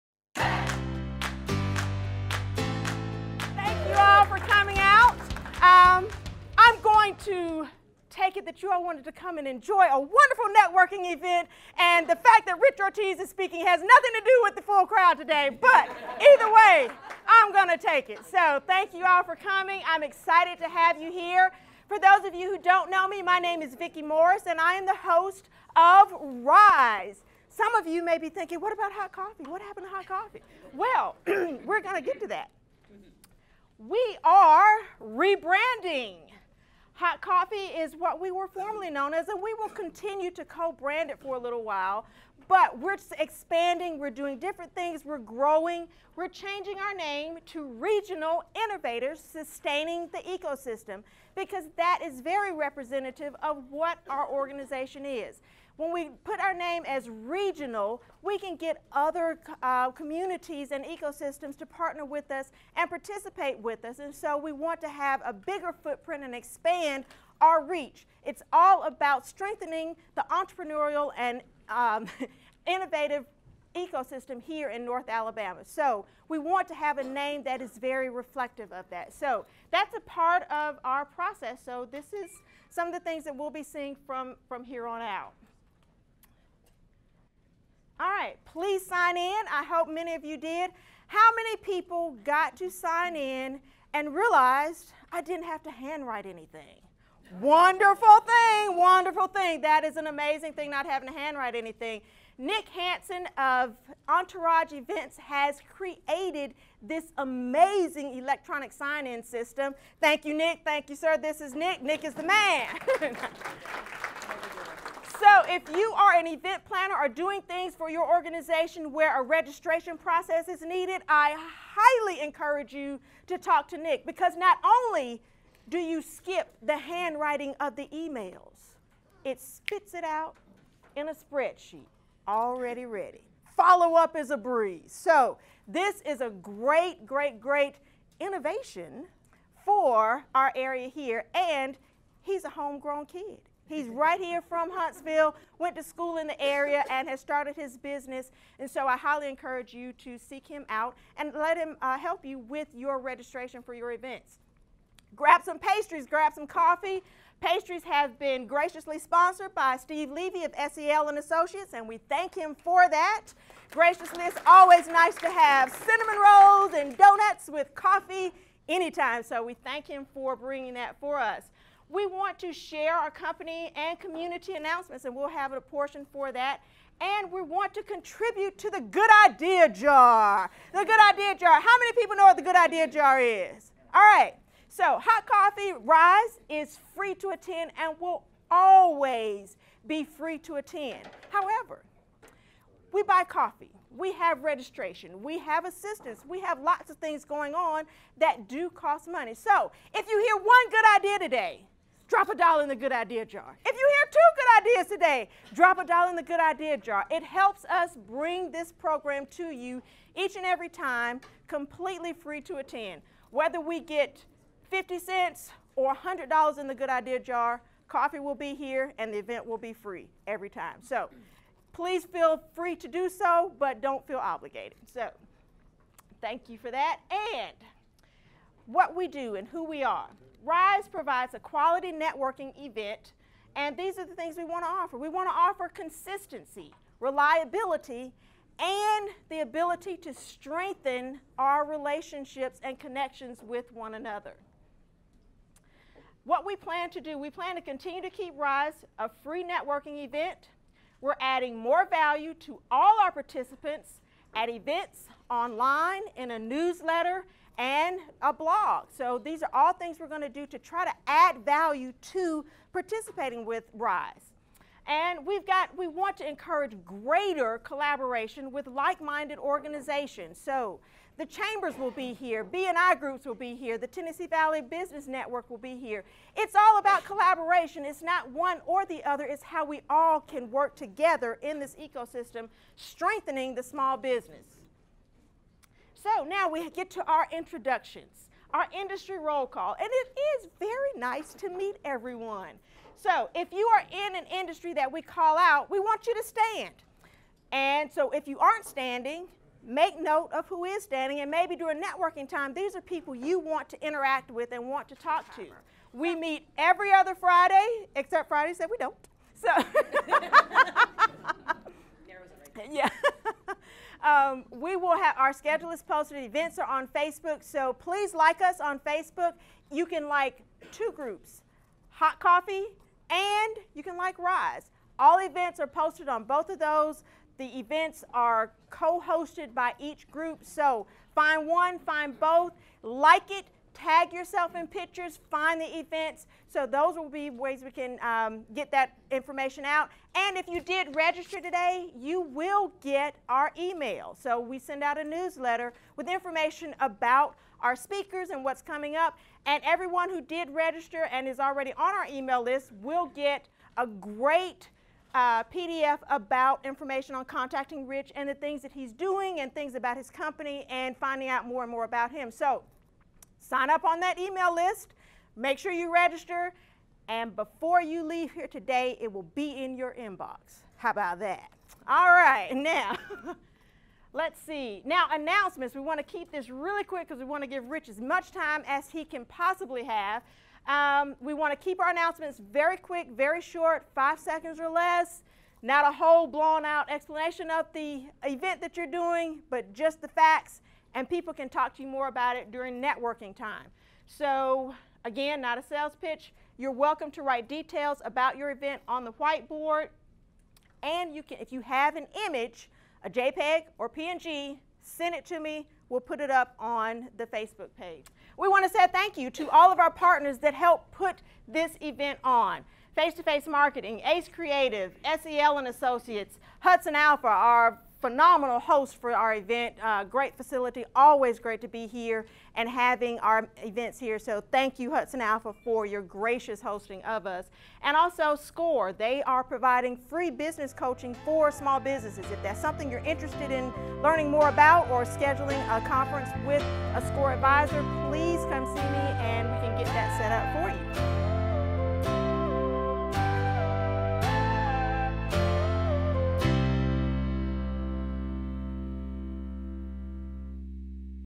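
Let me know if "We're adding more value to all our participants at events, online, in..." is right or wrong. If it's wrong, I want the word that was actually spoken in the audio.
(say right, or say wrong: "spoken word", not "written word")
right.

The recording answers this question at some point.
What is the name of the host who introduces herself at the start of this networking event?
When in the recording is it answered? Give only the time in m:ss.
0:23.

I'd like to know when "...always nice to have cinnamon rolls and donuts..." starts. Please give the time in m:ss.
2:44.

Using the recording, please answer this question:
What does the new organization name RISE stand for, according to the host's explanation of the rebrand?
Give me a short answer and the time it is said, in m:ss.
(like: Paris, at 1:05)
Regional Innovators Sustaining the Ecosystem, at 0:47.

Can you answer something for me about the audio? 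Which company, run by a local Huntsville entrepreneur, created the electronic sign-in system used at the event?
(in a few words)
Entourage Events.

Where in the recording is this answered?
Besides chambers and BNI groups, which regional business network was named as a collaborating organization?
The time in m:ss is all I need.
4:33.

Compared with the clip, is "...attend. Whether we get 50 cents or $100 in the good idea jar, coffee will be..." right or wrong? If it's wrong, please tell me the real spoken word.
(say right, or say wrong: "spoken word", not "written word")
right.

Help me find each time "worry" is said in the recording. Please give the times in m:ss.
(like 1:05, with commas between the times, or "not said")
not said.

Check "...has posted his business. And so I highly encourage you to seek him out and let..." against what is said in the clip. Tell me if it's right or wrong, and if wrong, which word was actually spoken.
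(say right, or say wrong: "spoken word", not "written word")
wrong: "started", not "posted".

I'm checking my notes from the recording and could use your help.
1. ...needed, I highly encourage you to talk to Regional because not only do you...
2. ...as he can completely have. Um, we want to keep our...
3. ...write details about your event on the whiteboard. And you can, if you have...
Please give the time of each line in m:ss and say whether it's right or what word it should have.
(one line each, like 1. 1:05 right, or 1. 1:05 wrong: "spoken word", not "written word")
1. 2:00 wrong: "Nick", not "Regional"
2. 6:18 wrong: "possibly", not "completely"
3. 6:37 right.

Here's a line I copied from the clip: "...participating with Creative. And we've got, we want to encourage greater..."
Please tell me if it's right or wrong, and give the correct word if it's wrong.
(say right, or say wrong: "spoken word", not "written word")
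wrong: "RISE", not "Creative".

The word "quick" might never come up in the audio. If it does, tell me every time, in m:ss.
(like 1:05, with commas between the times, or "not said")
6:16, 6:22.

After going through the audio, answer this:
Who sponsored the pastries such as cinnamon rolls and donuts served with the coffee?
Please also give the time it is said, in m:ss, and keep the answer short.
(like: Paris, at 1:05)
Steve Levy, at 2:39.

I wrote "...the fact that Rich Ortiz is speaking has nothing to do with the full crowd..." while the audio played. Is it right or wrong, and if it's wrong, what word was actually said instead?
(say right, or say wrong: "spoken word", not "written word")
right.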